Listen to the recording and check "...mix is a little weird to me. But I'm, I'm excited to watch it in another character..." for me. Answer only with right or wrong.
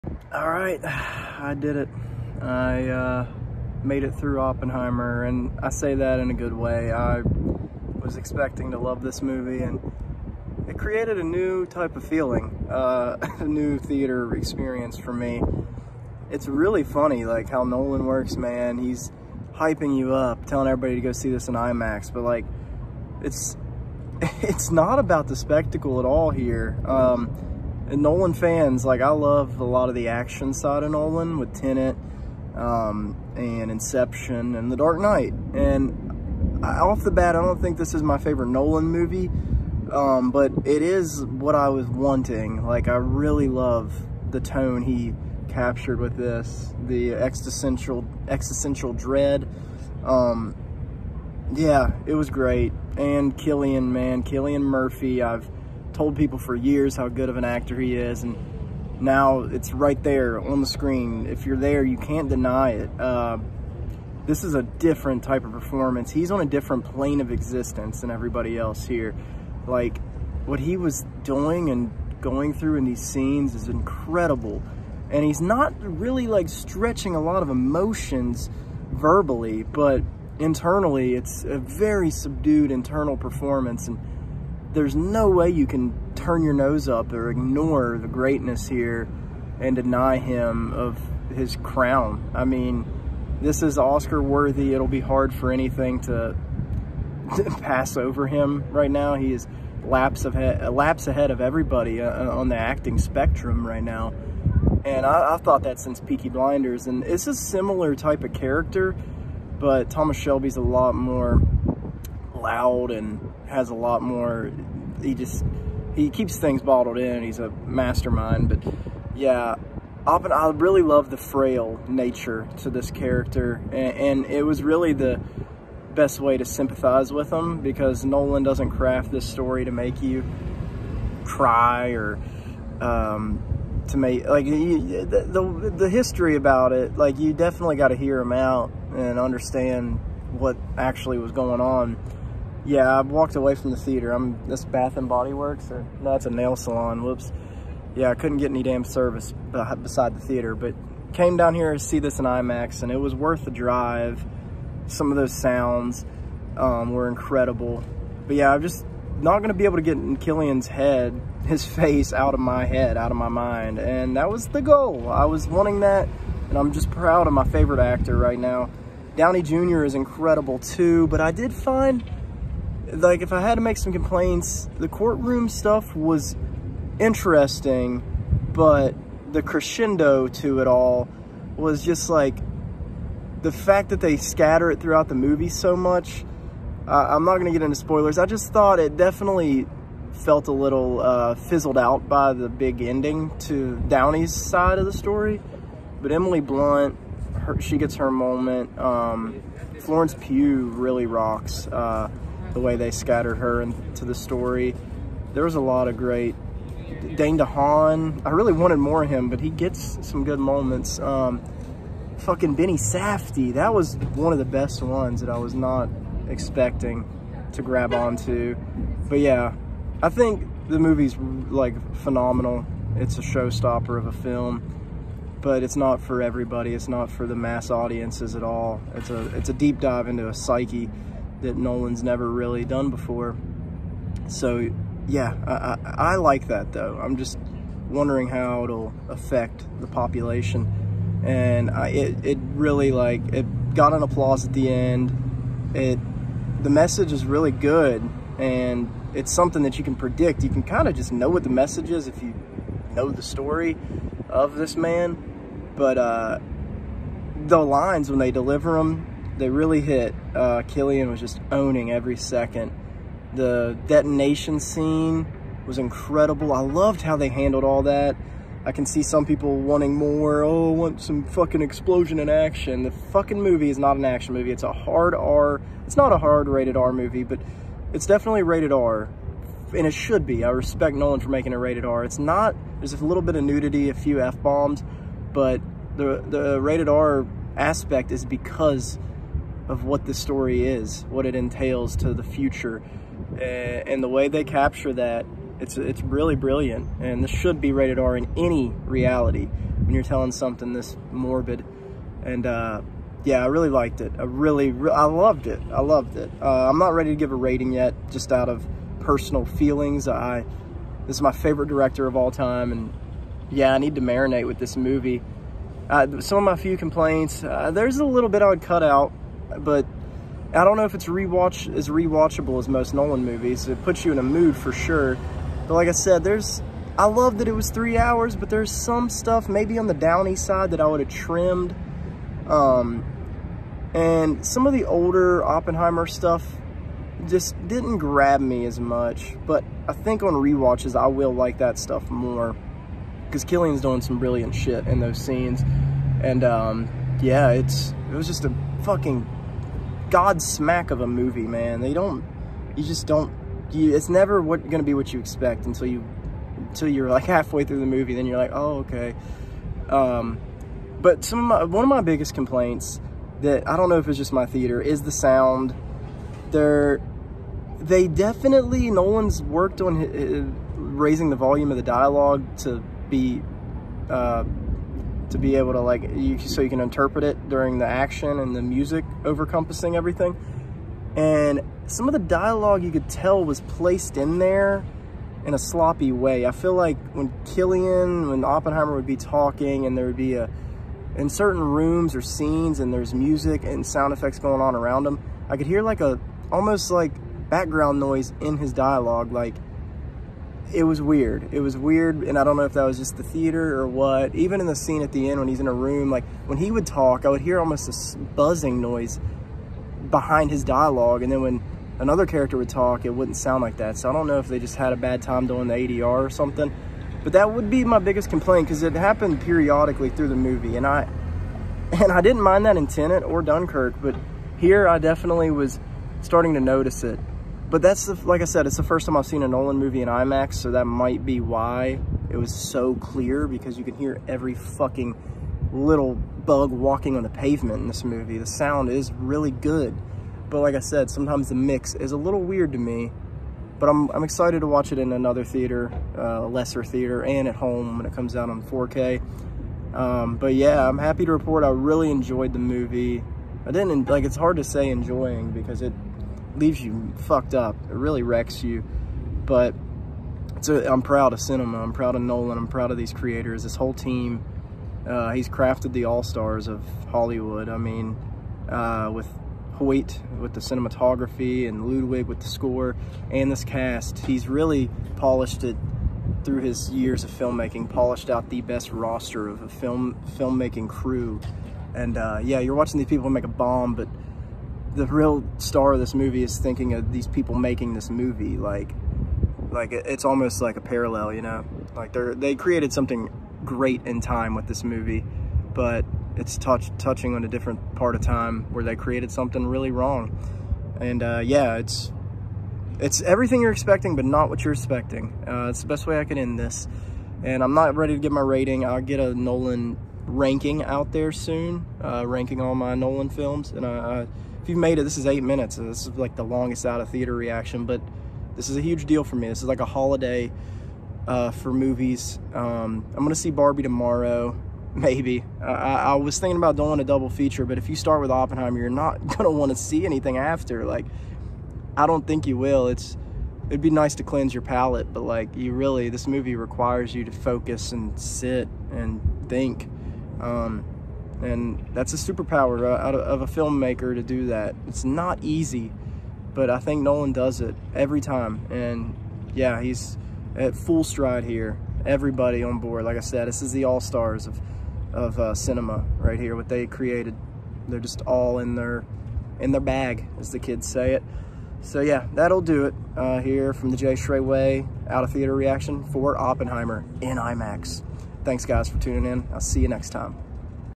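wrong.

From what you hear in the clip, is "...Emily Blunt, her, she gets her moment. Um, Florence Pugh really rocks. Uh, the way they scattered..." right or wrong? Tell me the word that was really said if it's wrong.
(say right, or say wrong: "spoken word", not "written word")
right.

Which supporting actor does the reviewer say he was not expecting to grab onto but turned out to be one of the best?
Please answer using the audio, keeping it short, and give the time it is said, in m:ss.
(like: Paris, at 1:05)
Benny Safdie, at 3:32.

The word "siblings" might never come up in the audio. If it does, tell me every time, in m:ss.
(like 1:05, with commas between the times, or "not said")
not said.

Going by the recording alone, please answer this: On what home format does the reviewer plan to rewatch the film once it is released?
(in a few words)
4K.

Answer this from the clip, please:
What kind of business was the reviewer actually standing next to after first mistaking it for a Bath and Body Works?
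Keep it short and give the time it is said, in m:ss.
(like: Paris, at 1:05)
nail salon, at 2:26.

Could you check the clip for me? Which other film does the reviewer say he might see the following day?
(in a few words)
Barbie.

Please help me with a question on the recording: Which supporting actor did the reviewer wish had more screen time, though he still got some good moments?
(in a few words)
Dane DeHaan.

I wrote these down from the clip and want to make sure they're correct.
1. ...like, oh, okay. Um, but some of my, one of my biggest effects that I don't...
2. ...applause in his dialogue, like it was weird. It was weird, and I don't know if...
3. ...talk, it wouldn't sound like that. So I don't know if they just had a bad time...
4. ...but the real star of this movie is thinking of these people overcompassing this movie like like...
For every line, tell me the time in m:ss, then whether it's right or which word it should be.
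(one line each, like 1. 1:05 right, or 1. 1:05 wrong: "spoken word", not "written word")
1. 5:58 wrong: "complaints", not "effects"
2. 6:37 wrong: "noise", not "applause"
3. 6:52 right
4. 8:03 wrong: "making", not "overcompassing".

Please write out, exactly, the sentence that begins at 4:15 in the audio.
But uh, the lines when they deliver them they really hit.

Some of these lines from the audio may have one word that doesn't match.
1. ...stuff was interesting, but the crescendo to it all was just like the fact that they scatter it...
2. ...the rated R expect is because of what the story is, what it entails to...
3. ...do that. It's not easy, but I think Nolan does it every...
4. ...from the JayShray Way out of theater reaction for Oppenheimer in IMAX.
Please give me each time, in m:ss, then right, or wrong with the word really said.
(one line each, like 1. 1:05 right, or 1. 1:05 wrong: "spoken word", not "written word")
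1. 2:55 right
2. 4:46 wrong: "aspect", not "expect"
3. 9:04 right
4. 9:23 right.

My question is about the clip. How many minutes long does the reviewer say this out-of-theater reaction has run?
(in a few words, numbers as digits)
8.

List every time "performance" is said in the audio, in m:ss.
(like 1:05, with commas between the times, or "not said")
1:05, 1:23.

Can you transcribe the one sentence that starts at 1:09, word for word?
Like, what he was doing and going through in these scenes is incredible.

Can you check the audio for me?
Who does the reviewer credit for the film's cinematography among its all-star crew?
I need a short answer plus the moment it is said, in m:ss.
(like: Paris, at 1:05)
Hoyt, at 7:49.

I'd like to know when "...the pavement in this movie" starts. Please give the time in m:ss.
7:17.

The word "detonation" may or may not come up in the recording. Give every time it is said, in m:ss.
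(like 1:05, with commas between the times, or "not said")
4:23.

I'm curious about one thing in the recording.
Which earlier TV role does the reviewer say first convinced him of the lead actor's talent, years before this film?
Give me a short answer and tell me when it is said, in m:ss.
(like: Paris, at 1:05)
Peaky Blinders, at 1:45.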